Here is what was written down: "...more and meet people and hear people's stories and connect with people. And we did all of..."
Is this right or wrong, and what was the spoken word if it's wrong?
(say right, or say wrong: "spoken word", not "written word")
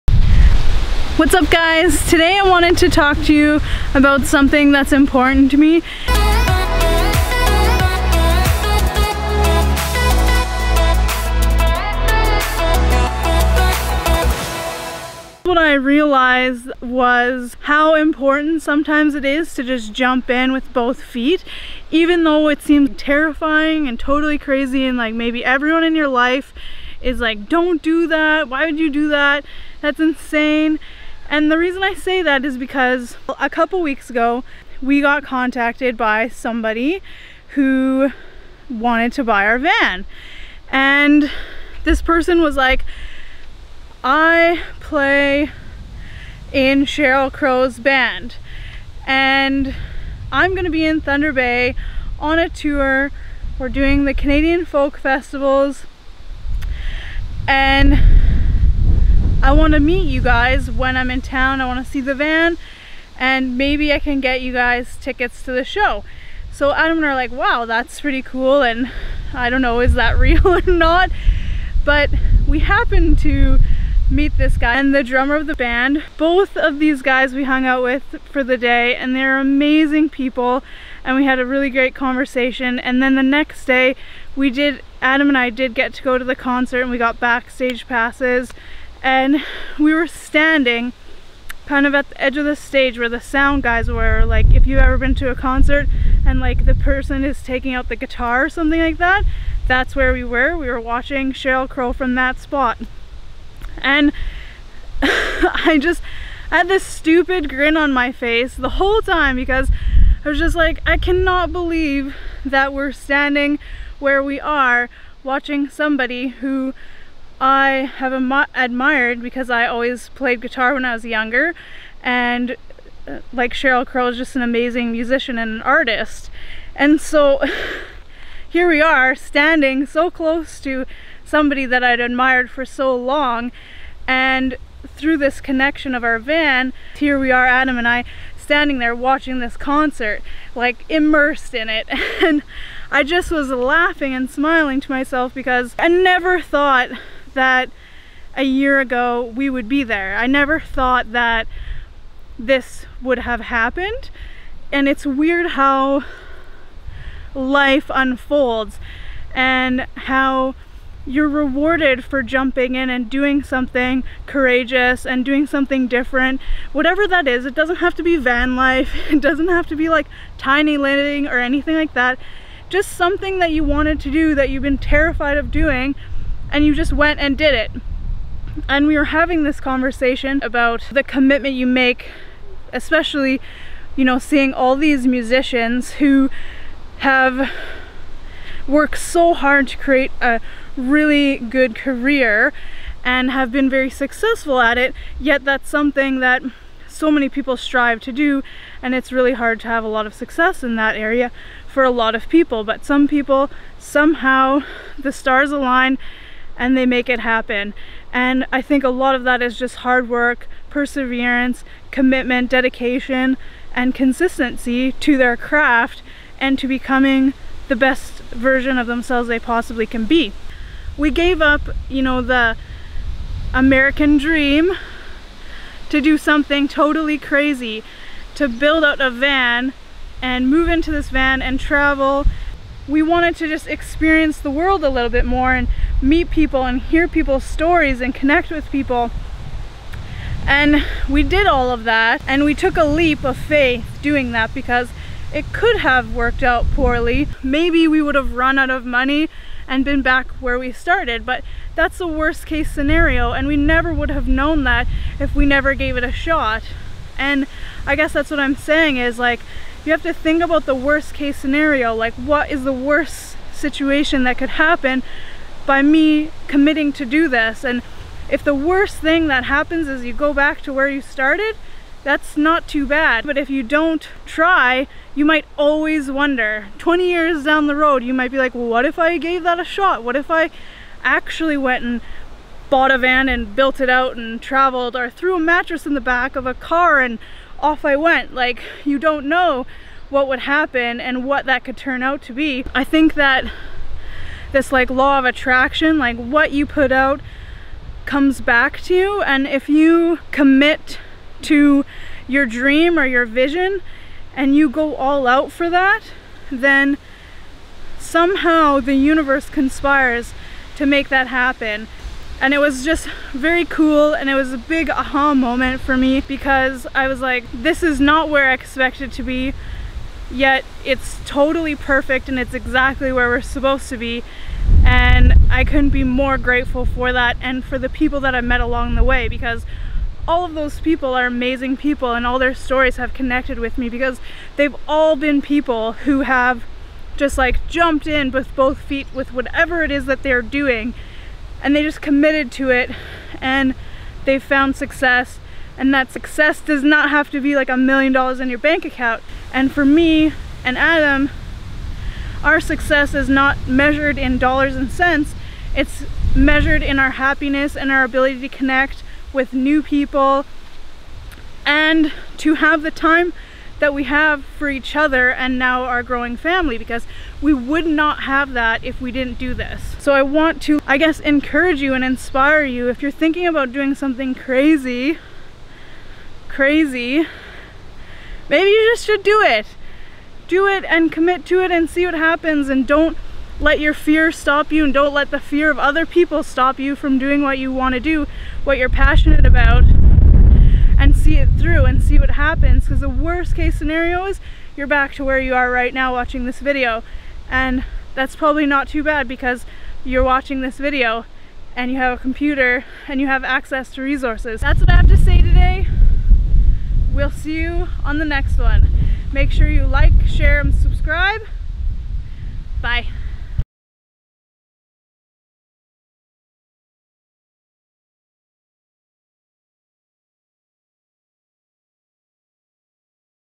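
right.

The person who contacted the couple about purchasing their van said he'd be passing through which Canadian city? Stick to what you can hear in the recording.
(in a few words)
Thunder Bay.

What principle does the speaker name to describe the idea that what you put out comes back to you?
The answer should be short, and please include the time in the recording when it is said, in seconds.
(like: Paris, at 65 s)
Law of attraction, at 294 s.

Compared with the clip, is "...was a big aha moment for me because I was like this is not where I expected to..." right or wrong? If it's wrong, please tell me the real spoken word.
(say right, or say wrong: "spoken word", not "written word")
right.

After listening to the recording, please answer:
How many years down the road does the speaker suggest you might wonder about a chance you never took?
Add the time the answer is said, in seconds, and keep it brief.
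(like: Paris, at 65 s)
20, at 276 s.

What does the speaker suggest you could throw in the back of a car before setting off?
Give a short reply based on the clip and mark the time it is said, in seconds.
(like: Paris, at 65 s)
A mattress, at 285 s.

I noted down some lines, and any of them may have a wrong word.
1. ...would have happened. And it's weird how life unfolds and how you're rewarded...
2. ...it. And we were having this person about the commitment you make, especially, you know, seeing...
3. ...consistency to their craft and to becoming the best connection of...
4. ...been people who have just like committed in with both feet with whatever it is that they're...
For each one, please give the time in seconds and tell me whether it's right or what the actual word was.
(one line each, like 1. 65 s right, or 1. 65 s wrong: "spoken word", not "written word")
1. 153 s right
2. 177 s wrong: "conversation", not "person"
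3. 213 s wrong: "version", not "connection"
4. 335 s wrong: "jumped", not "committed".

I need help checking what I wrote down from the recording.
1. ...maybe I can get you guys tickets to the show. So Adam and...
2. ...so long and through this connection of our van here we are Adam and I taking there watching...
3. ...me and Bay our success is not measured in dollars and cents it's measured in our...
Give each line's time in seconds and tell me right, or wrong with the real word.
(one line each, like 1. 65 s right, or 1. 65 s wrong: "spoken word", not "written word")
1. 63 s right
2. 132 s wrong: "standing", not "taking"
3. 349 s wrong: "Adam", not "Bay".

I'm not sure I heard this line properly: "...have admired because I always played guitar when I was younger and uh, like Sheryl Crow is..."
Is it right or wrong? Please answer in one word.
right.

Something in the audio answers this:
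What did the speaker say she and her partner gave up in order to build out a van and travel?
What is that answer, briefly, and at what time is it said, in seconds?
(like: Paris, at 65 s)
The American dream, at 222 s.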